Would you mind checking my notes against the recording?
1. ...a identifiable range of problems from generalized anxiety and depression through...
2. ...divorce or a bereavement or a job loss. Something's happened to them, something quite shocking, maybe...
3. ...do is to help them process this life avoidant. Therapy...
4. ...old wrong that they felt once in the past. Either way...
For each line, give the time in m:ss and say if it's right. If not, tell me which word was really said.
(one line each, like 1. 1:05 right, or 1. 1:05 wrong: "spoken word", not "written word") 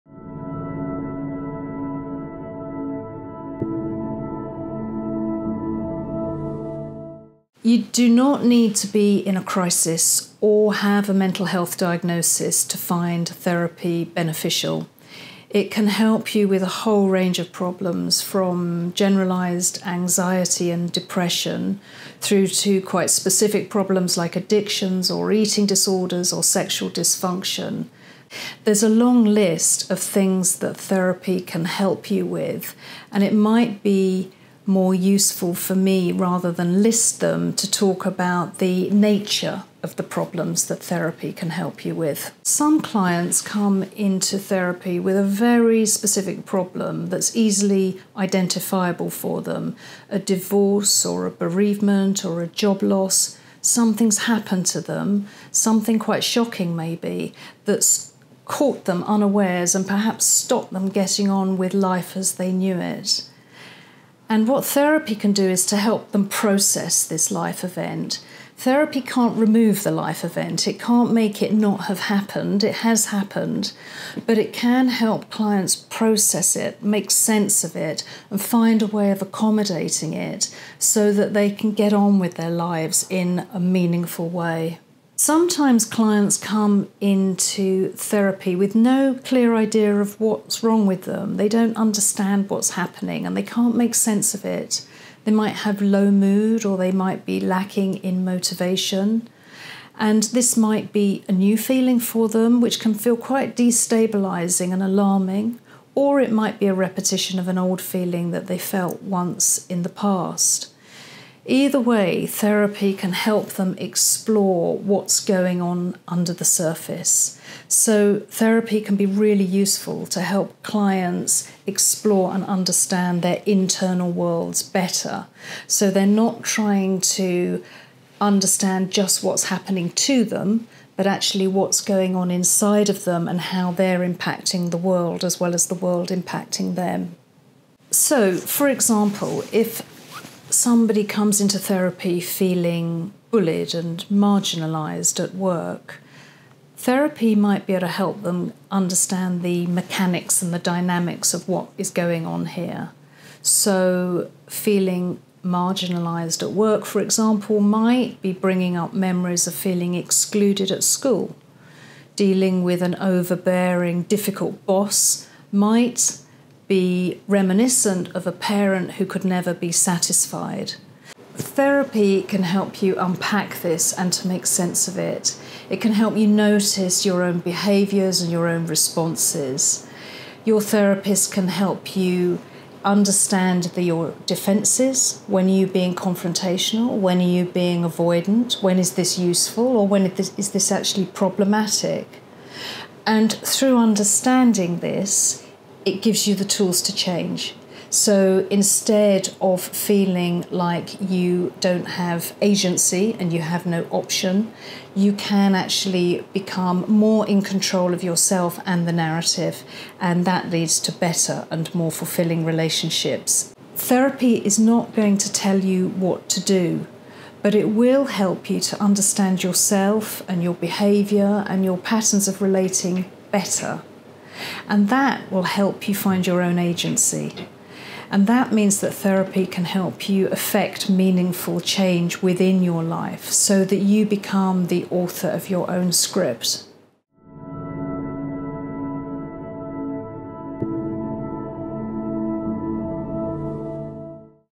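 1. 0:16 wrong: "whole", not "identifiable"
2. 0:50 right
3. 1:05 wrong: "event", not "avoidant"
4. 1:47 wrong: "feeling", not "wrong".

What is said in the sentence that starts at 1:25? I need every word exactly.
Sometimes clients come into therapy with no clear idea of what's wrong with them.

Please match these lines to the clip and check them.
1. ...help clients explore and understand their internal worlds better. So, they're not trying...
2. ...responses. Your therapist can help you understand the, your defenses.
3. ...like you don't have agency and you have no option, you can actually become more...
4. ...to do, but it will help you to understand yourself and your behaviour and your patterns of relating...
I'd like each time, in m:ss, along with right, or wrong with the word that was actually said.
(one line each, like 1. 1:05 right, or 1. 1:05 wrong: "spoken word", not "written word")
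1. 2:00 right
2. 2:58 right
3. 3:20 right
4. 3:36 right.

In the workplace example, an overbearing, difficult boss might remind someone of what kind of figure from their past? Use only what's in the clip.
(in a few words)
A parent.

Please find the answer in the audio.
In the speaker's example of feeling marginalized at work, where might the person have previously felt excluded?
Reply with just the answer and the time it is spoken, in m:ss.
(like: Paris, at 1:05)
At school, at 2:40.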